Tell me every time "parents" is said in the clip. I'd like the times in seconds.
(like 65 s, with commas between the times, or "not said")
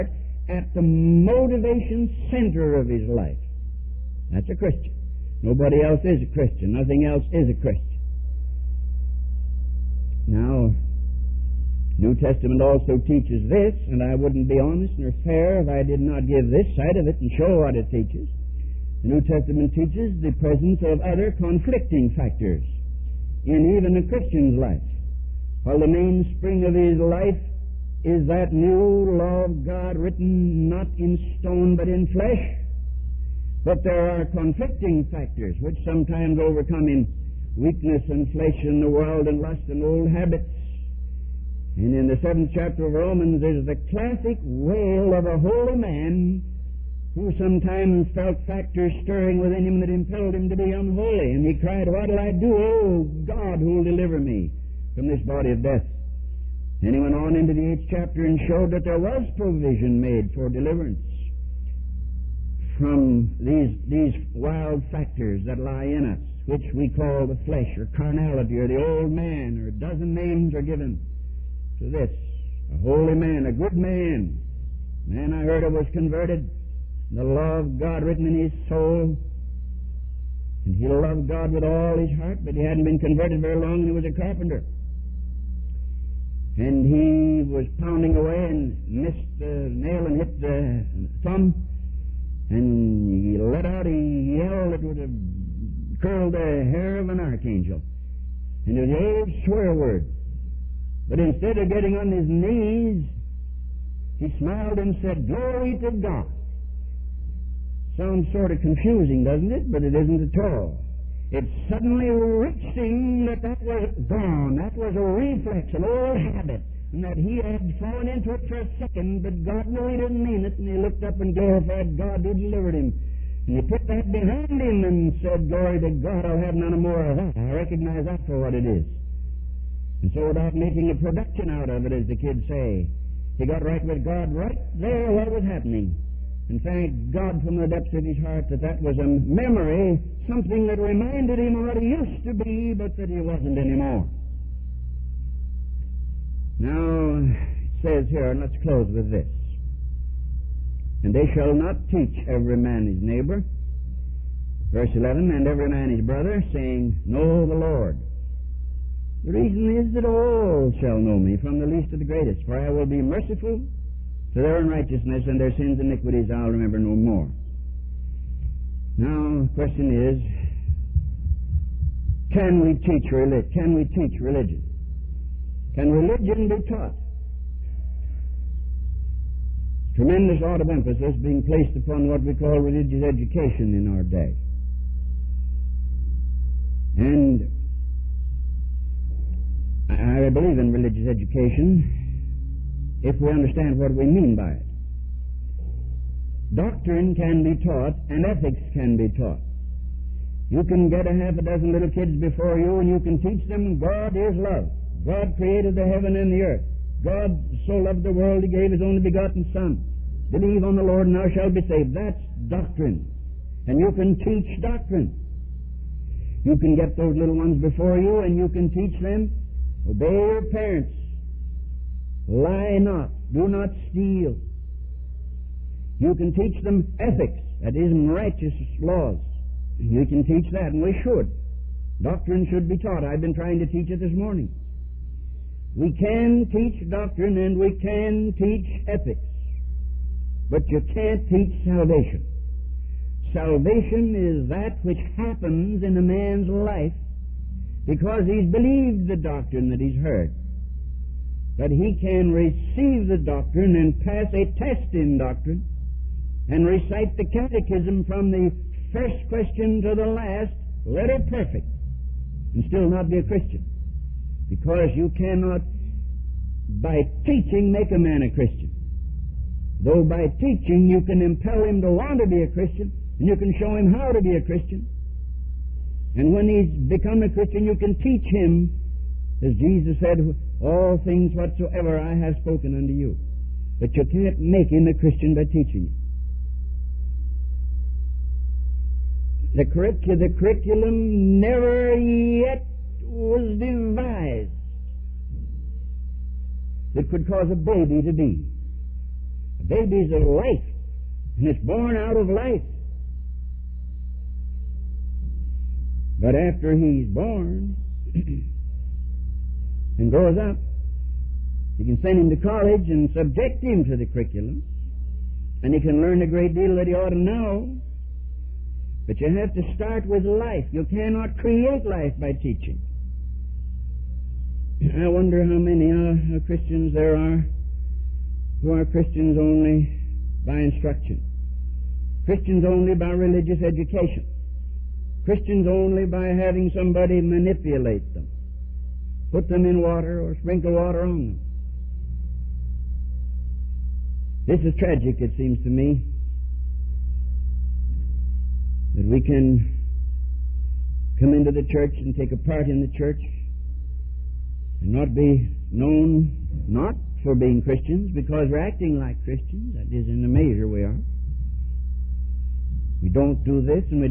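220 s.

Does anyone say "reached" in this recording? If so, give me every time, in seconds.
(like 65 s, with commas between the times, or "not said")
112 s.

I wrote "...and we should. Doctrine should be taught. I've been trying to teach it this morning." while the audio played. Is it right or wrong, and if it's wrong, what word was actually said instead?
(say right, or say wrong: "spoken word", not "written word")
right.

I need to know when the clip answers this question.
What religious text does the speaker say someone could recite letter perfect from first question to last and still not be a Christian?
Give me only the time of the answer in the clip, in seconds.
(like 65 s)
257 s.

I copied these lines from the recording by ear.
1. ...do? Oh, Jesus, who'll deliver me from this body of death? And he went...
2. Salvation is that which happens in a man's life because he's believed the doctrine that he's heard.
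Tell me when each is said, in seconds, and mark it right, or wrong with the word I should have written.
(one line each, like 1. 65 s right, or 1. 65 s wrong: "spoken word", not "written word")
1. 52 s wrong: "God", not "Jesus"
2. 243 s right.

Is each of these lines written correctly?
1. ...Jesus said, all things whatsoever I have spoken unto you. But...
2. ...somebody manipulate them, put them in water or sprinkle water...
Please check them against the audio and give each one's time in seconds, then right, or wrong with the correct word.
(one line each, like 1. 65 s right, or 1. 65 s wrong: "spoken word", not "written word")
1. 279 s right
2. 336 s right.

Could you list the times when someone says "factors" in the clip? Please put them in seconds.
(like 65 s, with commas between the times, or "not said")
22 s, 35 s, 48 s, 64 s.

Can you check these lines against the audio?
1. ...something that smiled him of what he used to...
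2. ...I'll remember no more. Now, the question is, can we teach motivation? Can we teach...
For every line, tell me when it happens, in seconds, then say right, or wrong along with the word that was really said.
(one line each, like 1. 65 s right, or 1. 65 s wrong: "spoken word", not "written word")
1. 140 s wrong: "reminded", not "smiled"
2. 166 s wrong: "religion", not "motivation".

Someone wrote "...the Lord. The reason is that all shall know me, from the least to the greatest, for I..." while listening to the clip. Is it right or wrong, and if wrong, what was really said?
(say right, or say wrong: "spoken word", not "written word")
right.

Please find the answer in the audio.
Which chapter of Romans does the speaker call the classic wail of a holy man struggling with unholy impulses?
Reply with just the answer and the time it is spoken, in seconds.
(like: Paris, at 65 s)
Seventh chapter, at 42 s.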